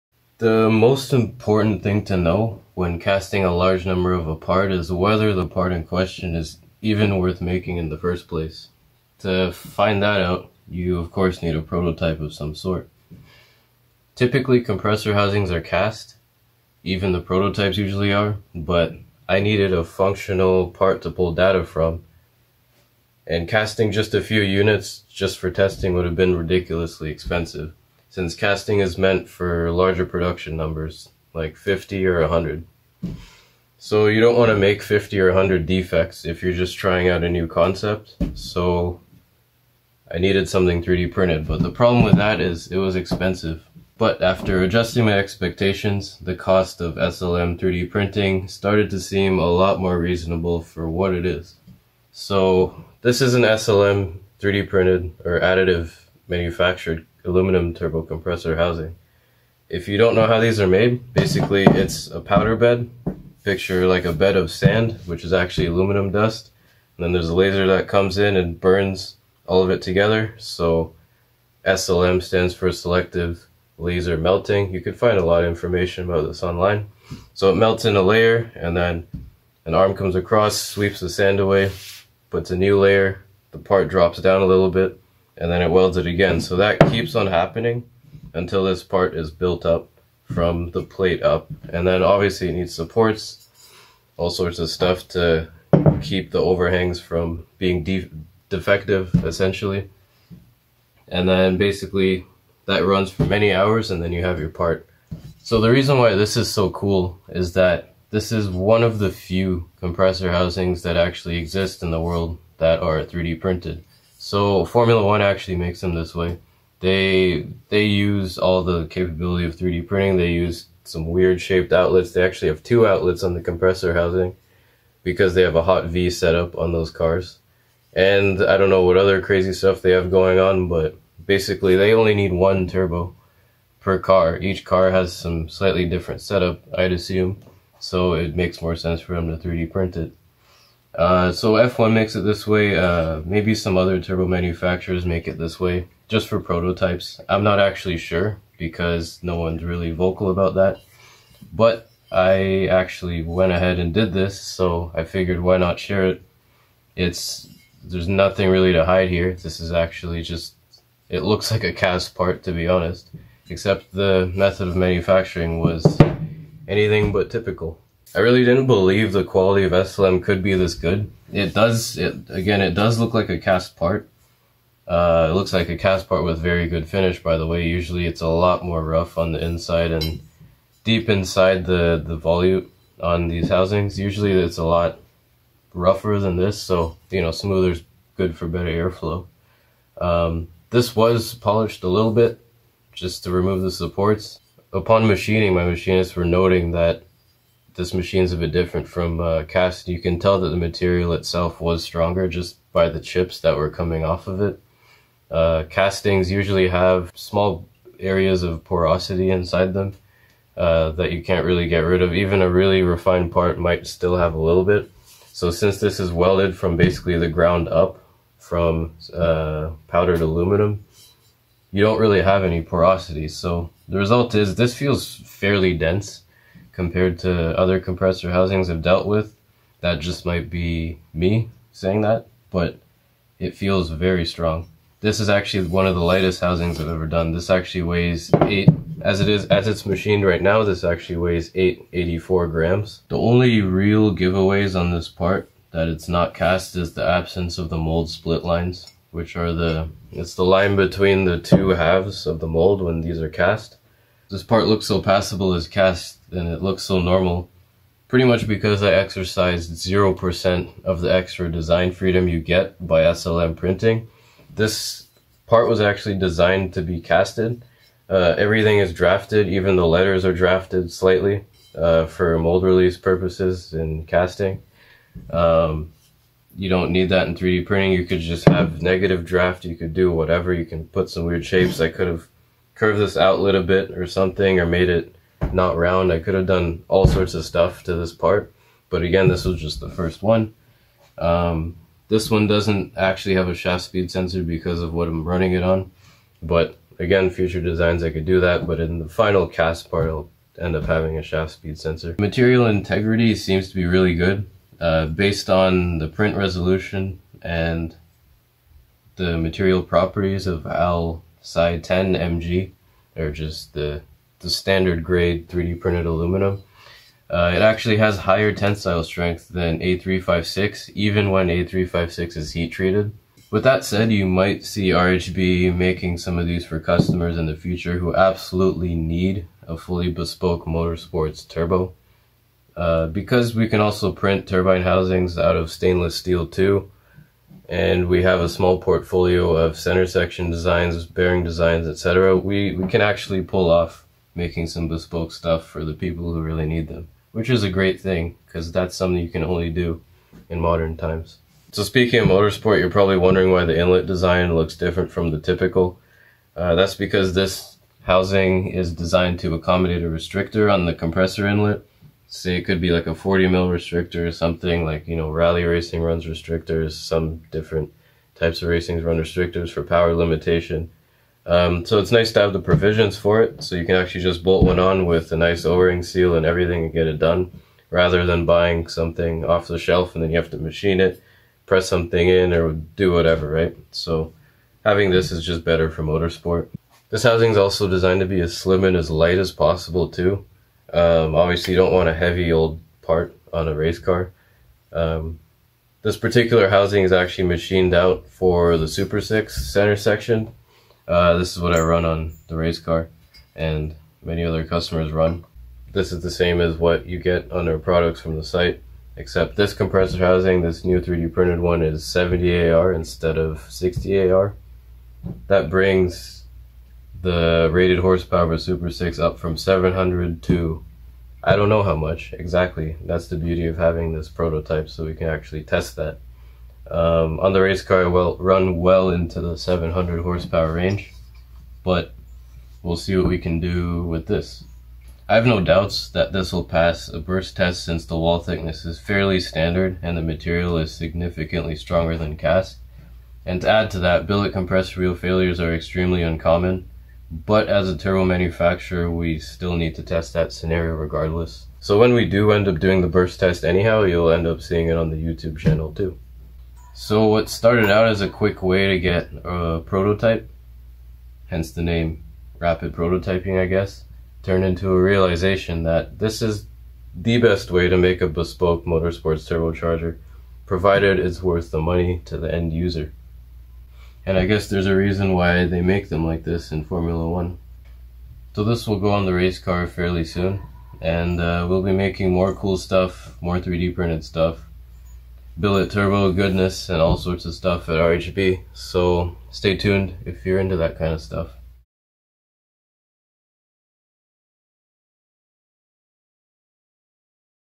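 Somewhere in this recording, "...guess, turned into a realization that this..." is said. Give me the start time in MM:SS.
07:43.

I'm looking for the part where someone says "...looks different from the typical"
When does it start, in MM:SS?
05:54.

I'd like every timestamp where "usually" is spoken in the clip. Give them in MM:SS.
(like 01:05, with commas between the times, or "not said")
00:17, 02:57, 03:03, 03:26.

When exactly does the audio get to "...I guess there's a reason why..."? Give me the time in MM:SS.
07:54.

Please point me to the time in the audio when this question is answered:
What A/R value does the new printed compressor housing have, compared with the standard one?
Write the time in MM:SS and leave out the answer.
06:52.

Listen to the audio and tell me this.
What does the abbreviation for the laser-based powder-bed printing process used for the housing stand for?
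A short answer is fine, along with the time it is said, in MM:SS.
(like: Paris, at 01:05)
selective laser melting, at 01:12.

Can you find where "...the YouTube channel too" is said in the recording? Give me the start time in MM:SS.
07:35.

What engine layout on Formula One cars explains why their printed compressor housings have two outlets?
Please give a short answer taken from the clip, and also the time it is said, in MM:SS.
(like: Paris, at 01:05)
hot V, at 02:05.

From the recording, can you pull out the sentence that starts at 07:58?
So this will go on the race car fairly soon.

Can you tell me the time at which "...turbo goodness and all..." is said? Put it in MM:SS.
08:05.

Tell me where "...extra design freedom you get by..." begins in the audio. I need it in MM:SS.
04:21.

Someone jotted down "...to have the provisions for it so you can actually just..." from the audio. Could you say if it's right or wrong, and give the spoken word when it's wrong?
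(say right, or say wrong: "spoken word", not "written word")
right.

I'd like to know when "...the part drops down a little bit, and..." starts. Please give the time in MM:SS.
01:23.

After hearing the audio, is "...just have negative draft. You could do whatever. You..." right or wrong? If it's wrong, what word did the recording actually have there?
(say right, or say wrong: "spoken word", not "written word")
right.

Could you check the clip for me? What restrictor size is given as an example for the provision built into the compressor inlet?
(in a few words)
40 mm.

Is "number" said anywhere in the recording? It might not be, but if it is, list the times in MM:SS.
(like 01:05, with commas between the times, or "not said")
00:03, 00:30.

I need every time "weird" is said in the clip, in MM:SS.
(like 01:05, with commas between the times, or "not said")
02:01, 04:41.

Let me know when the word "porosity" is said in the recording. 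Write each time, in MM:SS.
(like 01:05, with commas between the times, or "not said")
03:28, 03:42.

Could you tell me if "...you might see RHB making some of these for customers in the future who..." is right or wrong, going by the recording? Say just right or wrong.
right.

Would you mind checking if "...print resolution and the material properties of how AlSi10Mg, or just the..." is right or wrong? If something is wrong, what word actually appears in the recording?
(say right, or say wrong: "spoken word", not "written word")
right.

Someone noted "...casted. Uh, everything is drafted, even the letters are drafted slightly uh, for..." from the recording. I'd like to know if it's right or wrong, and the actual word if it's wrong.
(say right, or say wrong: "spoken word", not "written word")
right.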